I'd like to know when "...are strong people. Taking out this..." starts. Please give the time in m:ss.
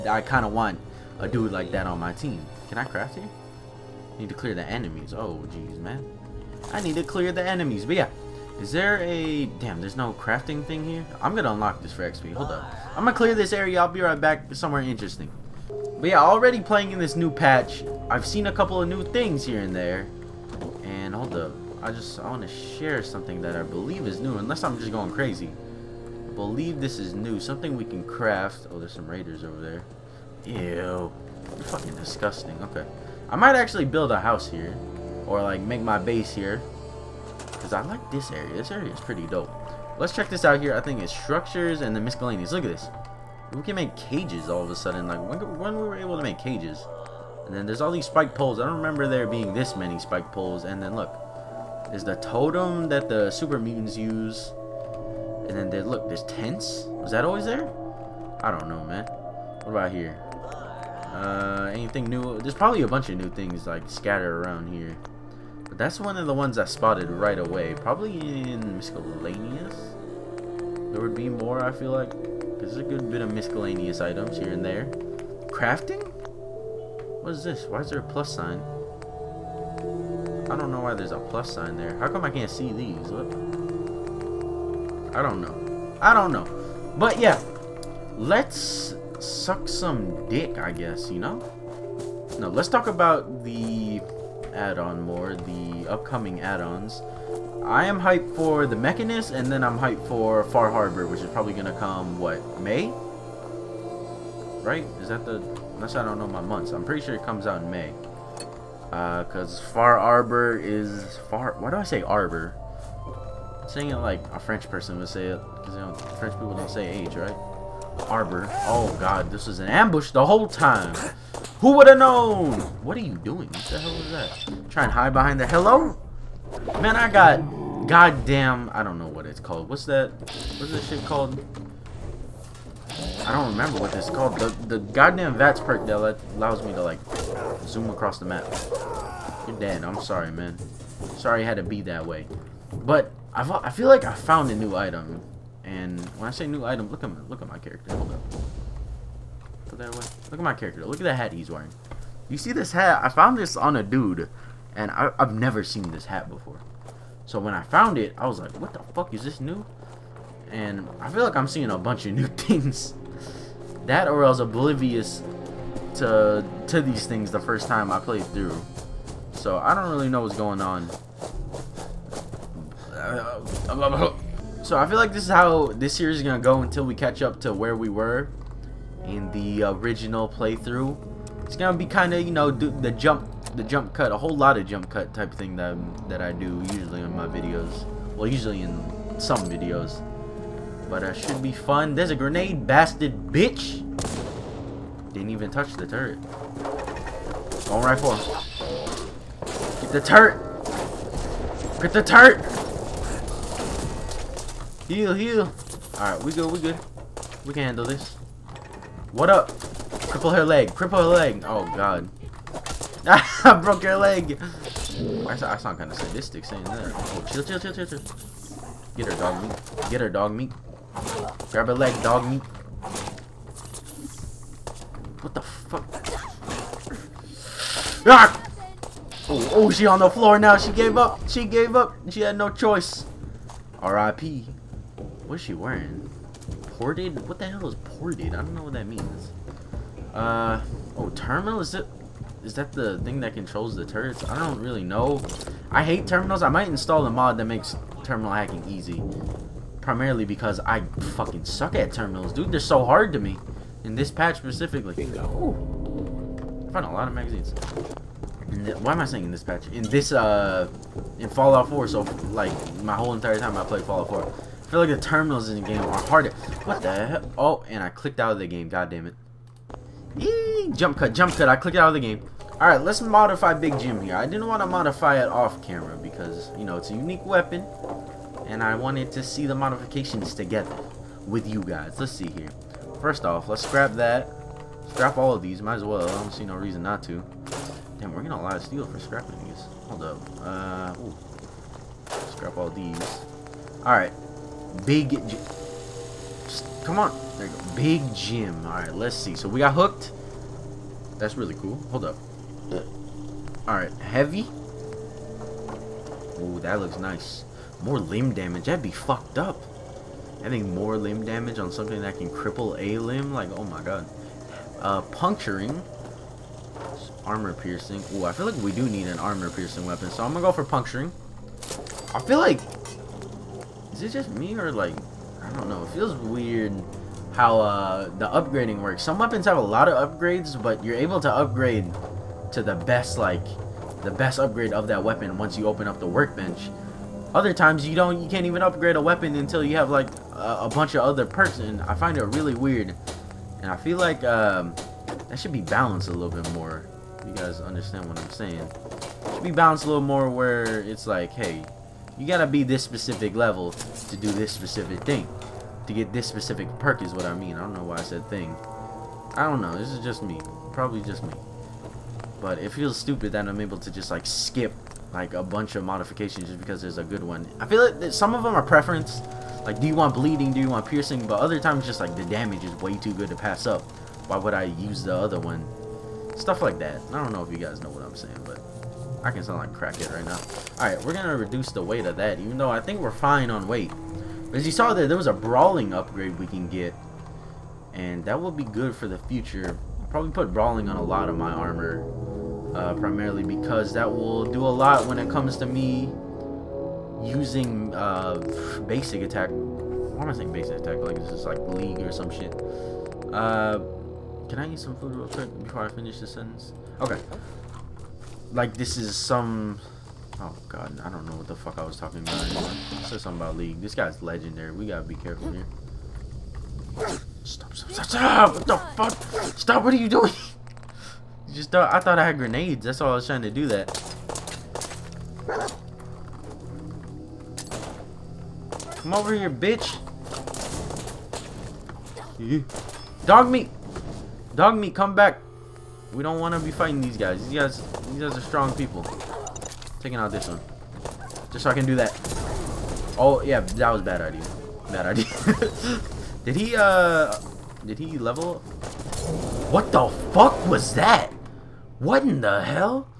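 7:18.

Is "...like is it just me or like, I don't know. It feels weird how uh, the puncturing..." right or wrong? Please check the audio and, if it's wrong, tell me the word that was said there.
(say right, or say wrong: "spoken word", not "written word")
wrong: "upgrading", not "puncturing".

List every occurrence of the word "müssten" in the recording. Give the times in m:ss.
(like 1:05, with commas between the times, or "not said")
not said.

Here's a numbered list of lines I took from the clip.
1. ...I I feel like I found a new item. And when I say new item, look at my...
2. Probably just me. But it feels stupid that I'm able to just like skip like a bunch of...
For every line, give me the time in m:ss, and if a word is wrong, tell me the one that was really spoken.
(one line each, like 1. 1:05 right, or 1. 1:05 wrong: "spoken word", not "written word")
1. 2:23 right
2. 6:00 right.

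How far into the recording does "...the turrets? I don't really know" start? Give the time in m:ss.
4:03.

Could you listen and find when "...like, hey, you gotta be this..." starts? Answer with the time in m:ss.
5:51.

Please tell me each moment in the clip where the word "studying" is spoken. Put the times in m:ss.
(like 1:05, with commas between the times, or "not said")
not said.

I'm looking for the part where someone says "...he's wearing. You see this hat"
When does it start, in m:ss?
2:31.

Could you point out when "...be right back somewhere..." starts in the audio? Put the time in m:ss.
0:13.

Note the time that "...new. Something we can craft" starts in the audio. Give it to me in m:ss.
0:27.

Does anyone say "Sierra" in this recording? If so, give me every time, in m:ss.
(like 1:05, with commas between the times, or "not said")
not said.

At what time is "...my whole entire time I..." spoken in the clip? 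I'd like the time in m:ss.
4:22.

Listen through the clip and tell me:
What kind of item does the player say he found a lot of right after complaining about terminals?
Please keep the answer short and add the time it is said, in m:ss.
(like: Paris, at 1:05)
Magazines, at 4:17.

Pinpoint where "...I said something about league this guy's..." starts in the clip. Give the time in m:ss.
6:52.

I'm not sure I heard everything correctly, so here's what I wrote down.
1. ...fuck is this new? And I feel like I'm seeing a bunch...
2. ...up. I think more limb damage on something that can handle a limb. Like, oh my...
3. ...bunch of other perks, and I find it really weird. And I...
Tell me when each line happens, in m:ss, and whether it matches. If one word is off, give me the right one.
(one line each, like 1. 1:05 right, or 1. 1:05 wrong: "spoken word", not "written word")
1. 2:38 right
2. 5:09 wrong: "cripple", not "handle"
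3. 5:40 right.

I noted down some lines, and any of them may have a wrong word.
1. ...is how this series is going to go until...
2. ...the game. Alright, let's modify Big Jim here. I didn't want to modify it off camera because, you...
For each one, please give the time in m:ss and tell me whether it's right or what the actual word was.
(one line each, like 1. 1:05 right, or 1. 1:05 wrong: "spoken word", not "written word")
1. 2:55 right
2. 4:31 right.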